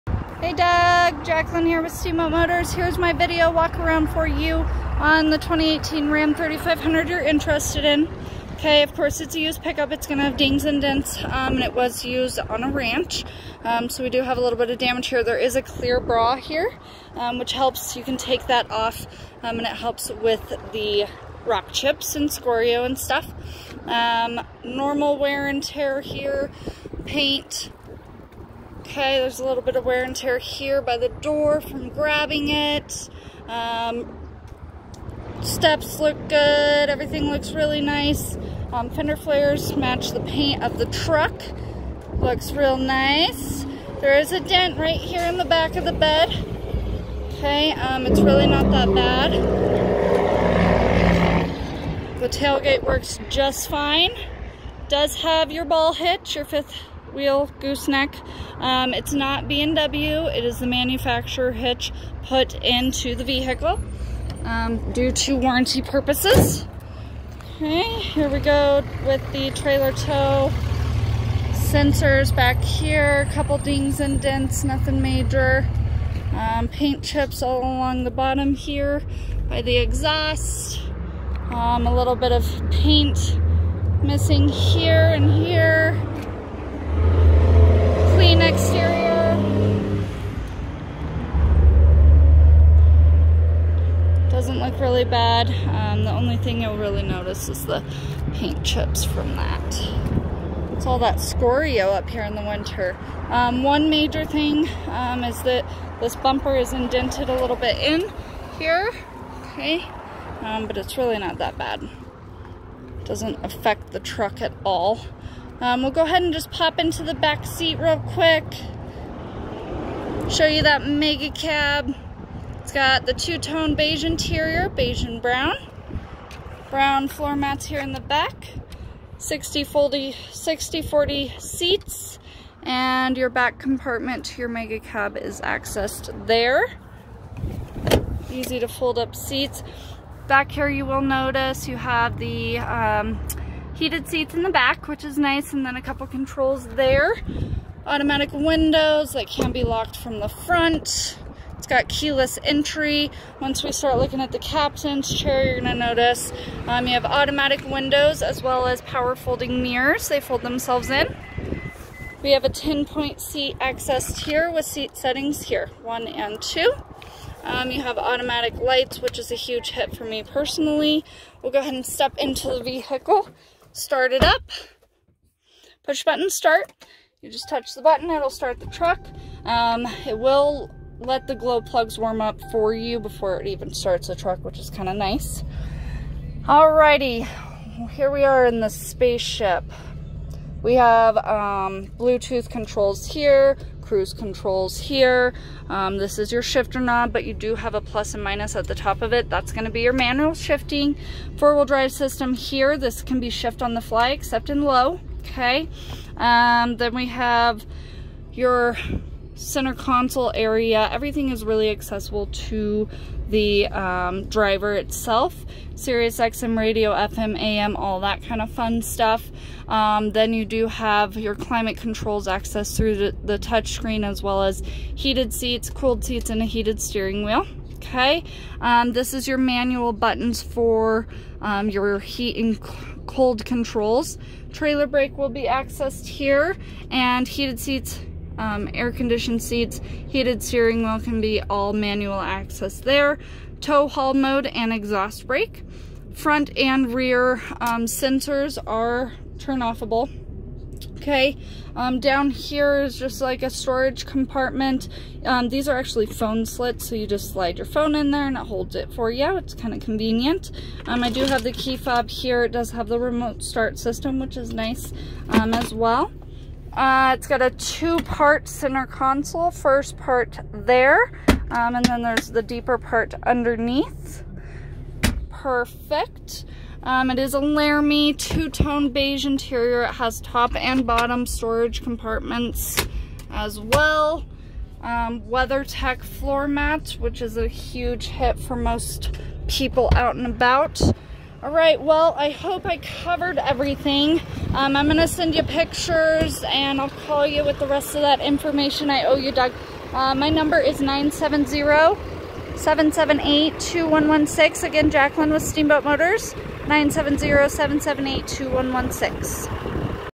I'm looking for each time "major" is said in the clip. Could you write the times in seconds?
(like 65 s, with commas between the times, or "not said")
75 s, 103 s.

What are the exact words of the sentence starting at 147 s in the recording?
Automatic windows that can be locked from the front.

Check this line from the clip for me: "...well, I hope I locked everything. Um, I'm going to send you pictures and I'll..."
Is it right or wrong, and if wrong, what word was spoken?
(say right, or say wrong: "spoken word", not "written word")
wrong: "covered", not "locked".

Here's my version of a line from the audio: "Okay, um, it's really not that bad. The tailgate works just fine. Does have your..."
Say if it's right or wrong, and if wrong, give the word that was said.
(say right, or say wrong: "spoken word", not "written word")
right.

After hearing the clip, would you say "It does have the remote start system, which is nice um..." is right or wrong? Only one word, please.
right.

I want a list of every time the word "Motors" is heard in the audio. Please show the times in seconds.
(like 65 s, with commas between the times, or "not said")
2 s, 305 s.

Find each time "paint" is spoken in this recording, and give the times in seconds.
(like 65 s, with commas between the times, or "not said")
27 s, 40 s, 76 s, 82 s, 98 s.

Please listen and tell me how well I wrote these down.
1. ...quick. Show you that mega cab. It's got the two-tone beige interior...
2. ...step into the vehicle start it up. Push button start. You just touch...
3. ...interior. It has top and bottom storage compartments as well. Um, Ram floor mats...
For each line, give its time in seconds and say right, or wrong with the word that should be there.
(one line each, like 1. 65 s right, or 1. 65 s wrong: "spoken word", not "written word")
1. 118 s right
2. 171 s right
3. 279 s wrong: "WeatherTech", not "Ram".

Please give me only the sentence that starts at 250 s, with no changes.
Okay, um, down here is just like a storage compartment.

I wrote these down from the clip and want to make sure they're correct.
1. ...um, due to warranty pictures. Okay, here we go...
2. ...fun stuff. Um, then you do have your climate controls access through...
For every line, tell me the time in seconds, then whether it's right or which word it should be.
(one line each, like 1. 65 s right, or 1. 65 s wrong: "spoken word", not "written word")
1. 64 s wrong: "purposes", not "pictures"
2. 218 s right.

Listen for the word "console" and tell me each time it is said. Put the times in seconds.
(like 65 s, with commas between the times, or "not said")
209 s, 268 s.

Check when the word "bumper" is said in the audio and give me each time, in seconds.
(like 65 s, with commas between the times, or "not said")
106 s.